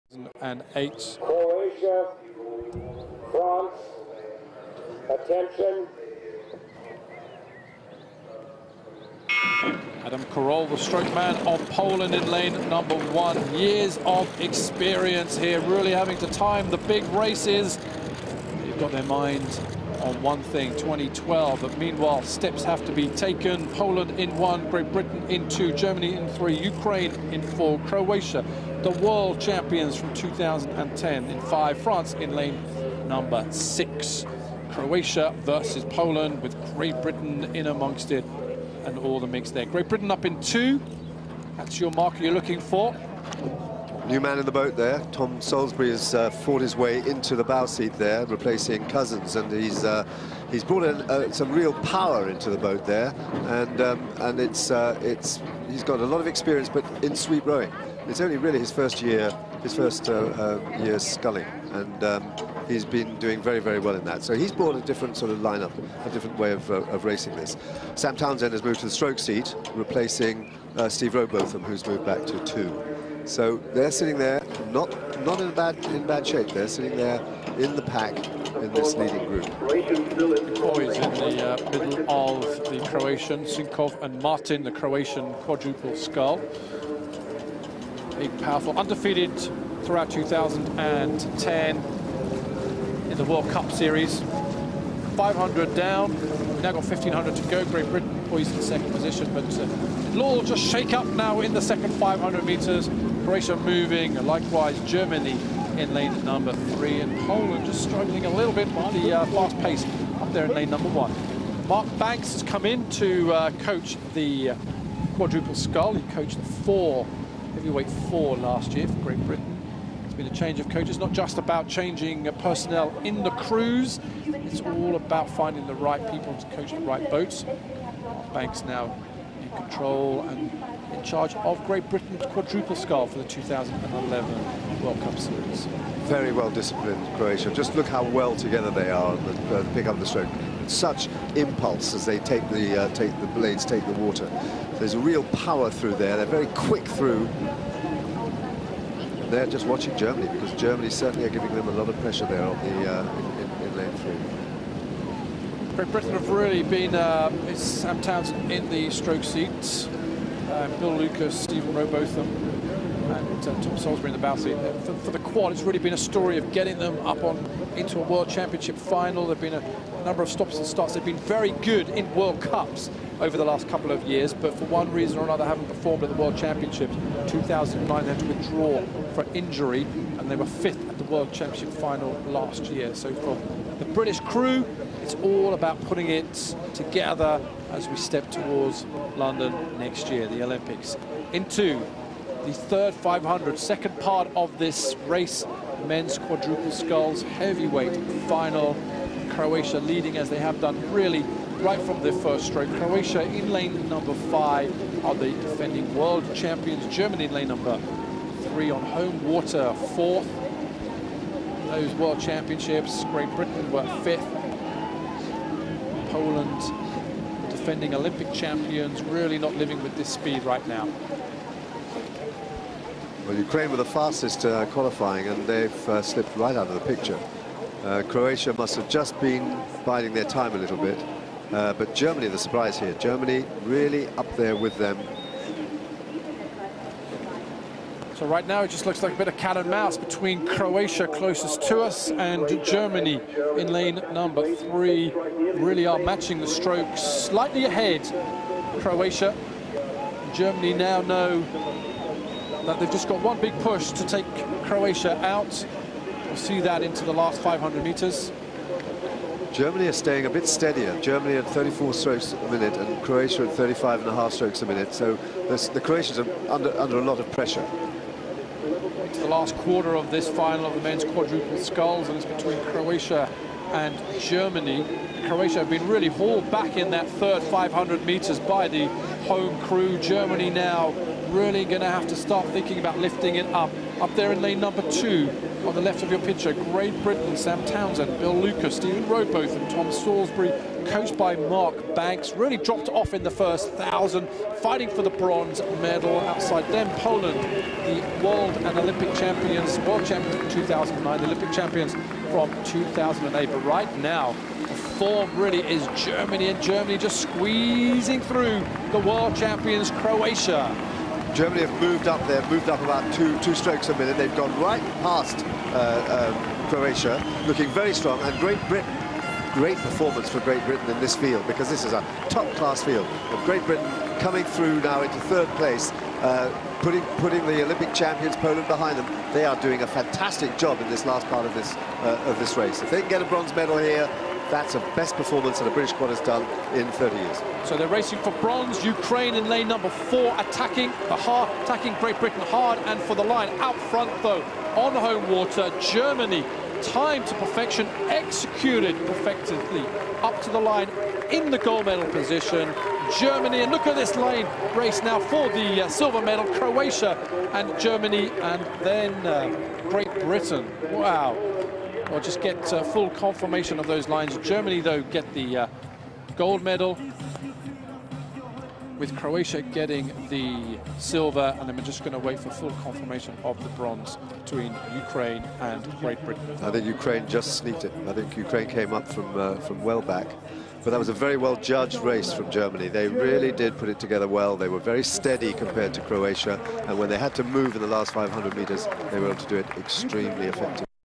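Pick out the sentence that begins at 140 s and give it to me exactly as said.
Such impulse as they take the, uh, take the blades, take the water.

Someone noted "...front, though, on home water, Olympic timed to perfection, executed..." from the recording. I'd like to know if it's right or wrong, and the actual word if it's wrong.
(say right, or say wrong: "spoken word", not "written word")
wrong: "Germany", not "Olympic".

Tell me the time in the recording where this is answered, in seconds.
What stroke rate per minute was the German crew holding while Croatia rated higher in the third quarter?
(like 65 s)
261 s.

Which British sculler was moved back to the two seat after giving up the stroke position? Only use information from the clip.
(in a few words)
Steve Robotham.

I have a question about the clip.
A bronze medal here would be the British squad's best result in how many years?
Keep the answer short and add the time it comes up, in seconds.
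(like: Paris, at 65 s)
30, at 336 s.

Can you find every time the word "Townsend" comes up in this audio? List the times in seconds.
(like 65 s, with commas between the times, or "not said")
68 s, 158 s, 287 s.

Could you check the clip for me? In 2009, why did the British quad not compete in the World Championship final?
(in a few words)
Injury.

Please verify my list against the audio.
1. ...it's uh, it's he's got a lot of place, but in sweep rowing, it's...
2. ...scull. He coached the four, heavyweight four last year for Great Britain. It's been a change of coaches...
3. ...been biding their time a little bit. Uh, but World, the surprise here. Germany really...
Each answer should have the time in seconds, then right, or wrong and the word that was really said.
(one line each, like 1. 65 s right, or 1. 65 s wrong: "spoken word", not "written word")
1. 54 s wrong: "experience", not "place"
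2. 115 s right
3. 229 s wrong: "Germany", not "World".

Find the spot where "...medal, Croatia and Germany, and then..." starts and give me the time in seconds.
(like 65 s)
356 s.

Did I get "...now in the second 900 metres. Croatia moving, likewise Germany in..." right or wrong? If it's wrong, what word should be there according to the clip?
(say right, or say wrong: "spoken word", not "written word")
wrong: "500", not "900".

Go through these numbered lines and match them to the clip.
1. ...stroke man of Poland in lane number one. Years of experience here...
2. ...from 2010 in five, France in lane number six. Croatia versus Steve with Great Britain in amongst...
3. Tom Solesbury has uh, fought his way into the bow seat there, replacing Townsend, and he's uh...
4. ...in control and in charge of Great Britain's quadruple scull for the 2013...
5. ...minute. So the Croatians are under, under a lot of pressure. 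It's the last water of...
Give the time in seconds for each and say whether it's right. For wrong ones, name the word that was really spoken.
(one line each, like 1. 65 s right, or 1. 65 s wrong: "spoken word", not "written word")
1. 10 s right
2. 29 s wrong: "Poland", not "Steve"
3. 45 s wrong: "Cousins", not "Townsend"
4. 129 s wrong: "2011", not "2013"
5. 264 s wrong: "quarter", not "water".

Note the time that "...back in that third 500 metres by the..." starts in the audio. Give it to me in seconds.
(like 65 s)
276 s.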